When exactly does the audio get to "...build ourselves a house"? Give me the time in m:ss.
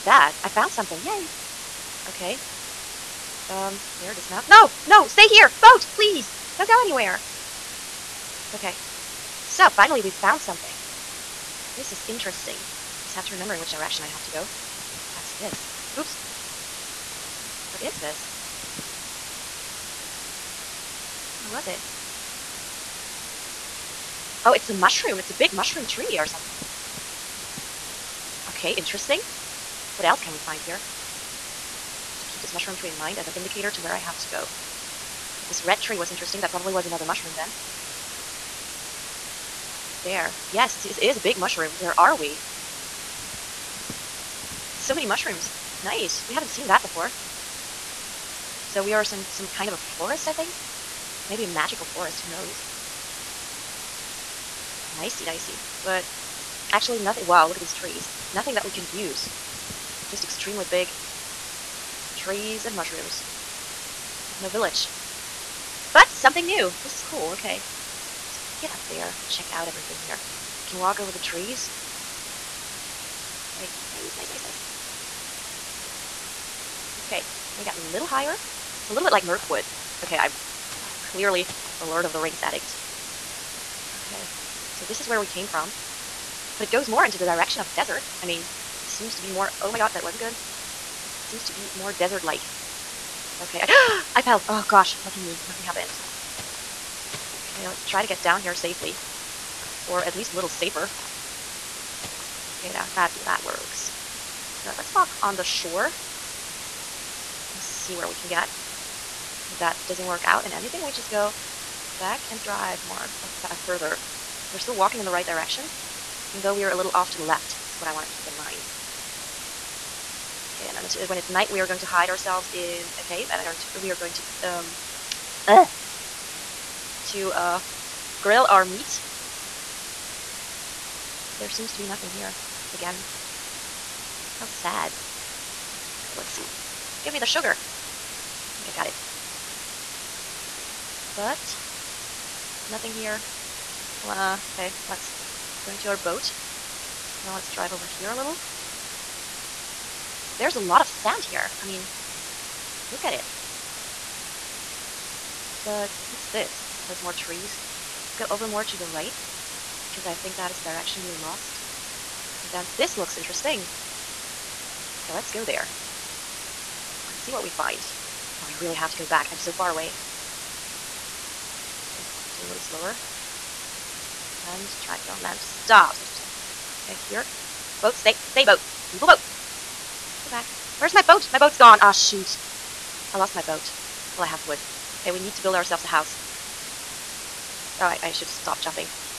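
3:05.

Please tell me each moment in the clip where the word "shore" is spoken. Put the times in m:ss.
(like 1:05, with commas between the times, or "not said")
1:45.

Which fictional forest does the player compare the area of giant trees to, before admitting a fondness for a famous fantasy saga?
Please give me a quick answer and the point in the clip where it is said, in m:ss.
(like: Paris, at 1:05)
Mirkwood, at 1:19.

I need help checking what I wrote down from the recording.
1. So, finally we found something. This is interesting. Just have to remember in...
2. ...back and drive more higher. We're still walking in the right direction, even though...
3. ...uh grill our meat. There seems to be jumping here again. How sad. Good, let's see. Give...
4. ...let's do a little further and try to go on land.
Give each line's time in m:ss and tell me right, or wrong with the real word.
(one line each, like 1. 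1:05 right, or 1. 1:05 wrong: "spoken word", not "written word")
1. 0:09 right
2. 1:51 wrong: "further", not "higher"
3. 2:07 wrong: "nothing", not "jumping"
4. 2:52 wrong: "slower", not "further".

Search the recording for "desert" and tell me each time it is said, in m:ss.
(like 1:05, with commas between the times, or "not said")
1:27, 1:31.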